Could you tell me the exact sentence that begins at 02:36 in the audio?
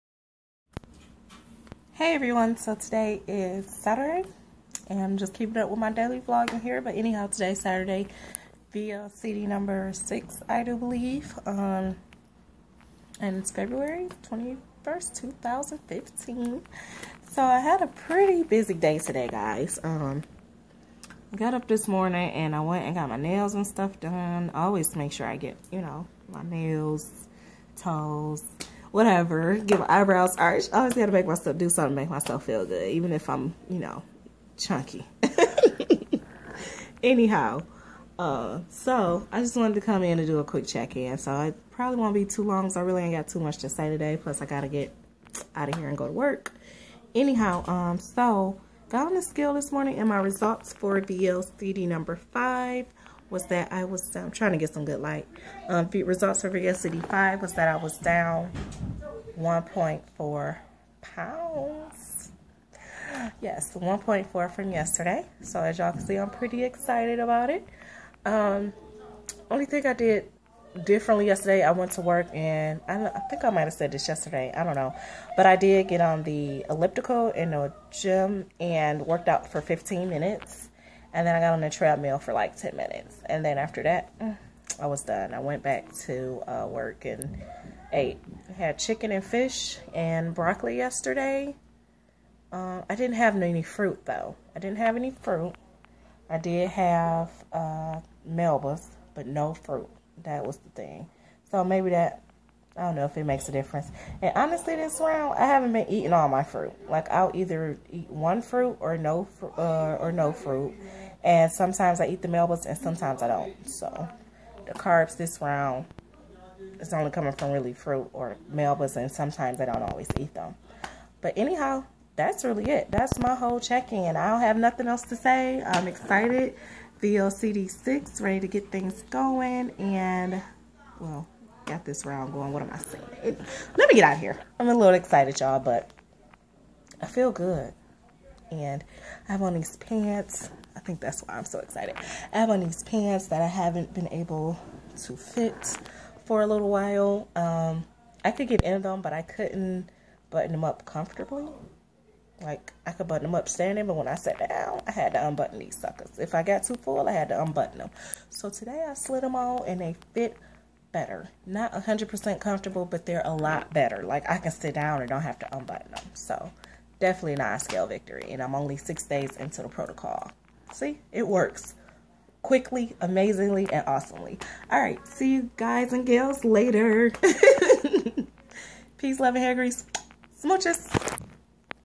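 If I got too full, I had to unbutton them.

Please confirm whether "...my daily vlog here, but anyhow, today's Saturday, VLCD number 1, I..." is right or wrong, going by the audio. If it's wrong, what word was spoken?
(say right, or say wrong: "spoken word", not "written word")
wrong: "6", not "1".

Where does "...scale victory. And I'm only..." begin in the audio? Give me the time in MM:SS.
02:47.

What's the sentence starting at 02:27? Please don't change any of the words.
Um, I could get in them, but I couldn't button them up comfortably.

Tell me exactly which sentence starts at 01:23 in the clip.
And then after that, I was done.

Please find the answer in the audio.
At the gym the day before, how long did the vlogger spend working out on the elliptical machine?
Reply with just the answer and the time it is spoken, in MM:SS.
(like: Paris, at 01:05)
15 minutes, at 01:19.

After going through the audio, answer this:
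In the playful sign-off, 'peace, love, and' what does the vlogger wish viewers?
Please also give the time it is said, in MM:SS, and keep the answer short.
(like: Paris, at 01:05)
hair grease, at 02:59.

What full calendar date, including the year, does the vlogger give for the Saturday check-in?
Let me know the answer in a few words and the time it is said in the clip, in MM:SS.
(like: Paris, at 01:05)
February 21, 2015, at 00:13.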